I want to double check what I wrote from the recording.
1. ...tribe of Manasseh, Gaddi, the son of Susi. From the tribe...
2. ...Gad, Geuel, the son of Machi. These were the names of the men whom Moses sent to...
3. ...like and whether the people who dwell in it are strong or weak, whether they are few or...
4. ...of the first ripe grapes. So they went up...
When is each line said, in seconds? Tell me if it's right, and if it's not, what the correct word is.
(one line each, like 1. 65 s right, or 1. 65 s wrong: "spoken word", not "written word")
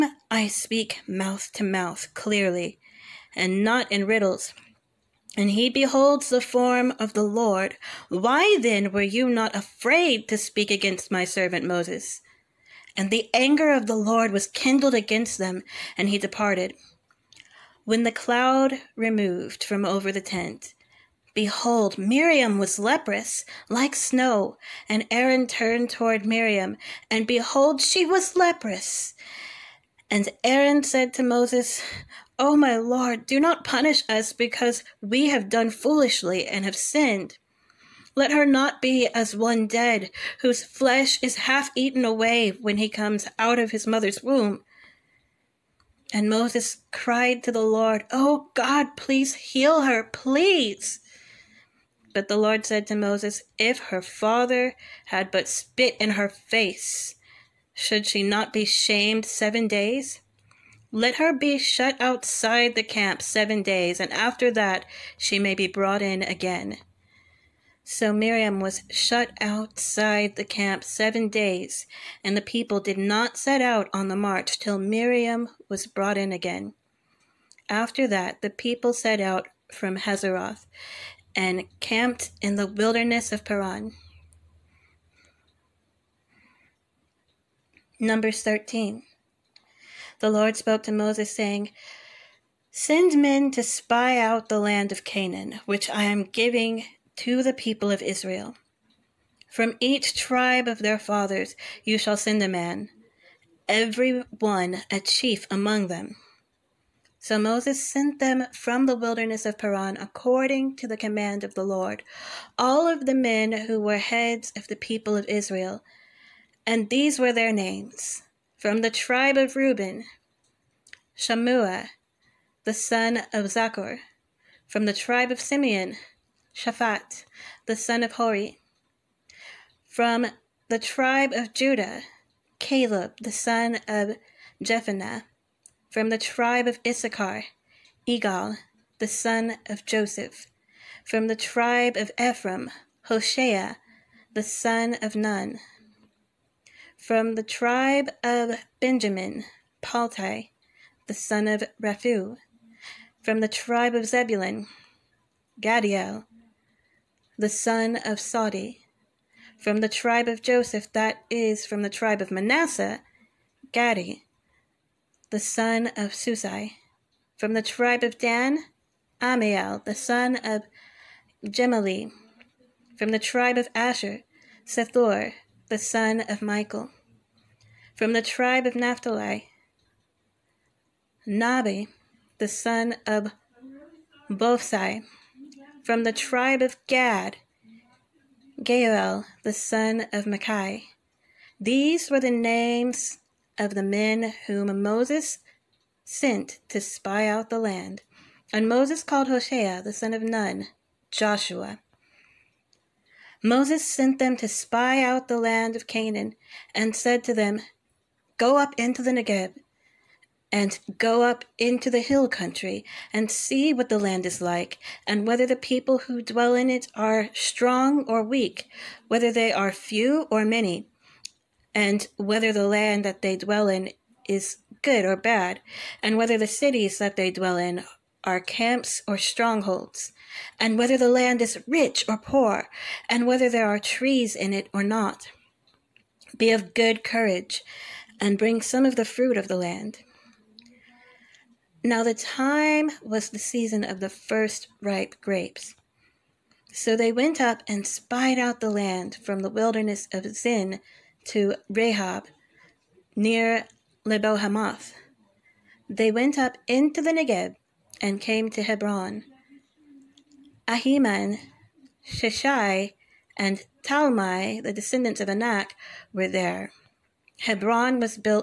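1. 161 s right
2. 186 s right
3. 214 s right
4. 243 s right.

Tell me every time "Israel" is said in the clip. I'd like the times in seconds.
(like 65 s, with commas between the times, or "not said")
98 s, 115 s.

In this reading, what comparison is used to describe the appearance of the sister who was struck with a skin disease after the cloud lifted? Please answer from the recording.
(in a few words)
like snow.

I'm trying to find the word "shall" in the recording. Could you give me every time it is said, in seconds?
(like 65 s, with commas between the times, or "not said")
101 s.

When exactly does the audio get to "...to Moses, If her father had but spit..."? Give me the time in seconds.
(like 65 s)
52 s.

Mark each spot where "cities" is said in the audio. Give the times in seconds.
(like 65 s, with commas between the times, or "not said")
226 s.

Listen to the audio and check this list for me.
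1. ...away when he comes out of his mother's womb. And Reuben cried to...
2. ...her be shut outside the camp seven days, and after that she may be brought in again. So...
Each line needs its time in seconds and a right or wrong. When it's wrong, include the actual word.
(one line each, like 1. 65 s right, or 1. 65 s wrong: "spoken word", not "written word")
1. 42 s wrong: "Moses", not "Reuben"
2. 61 s right.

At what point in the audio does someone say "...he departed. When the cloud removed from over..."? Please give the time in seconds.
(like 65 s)
16 s.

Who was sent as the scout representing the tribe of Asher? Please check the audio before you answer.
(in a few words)
Sethur, the son of Michael.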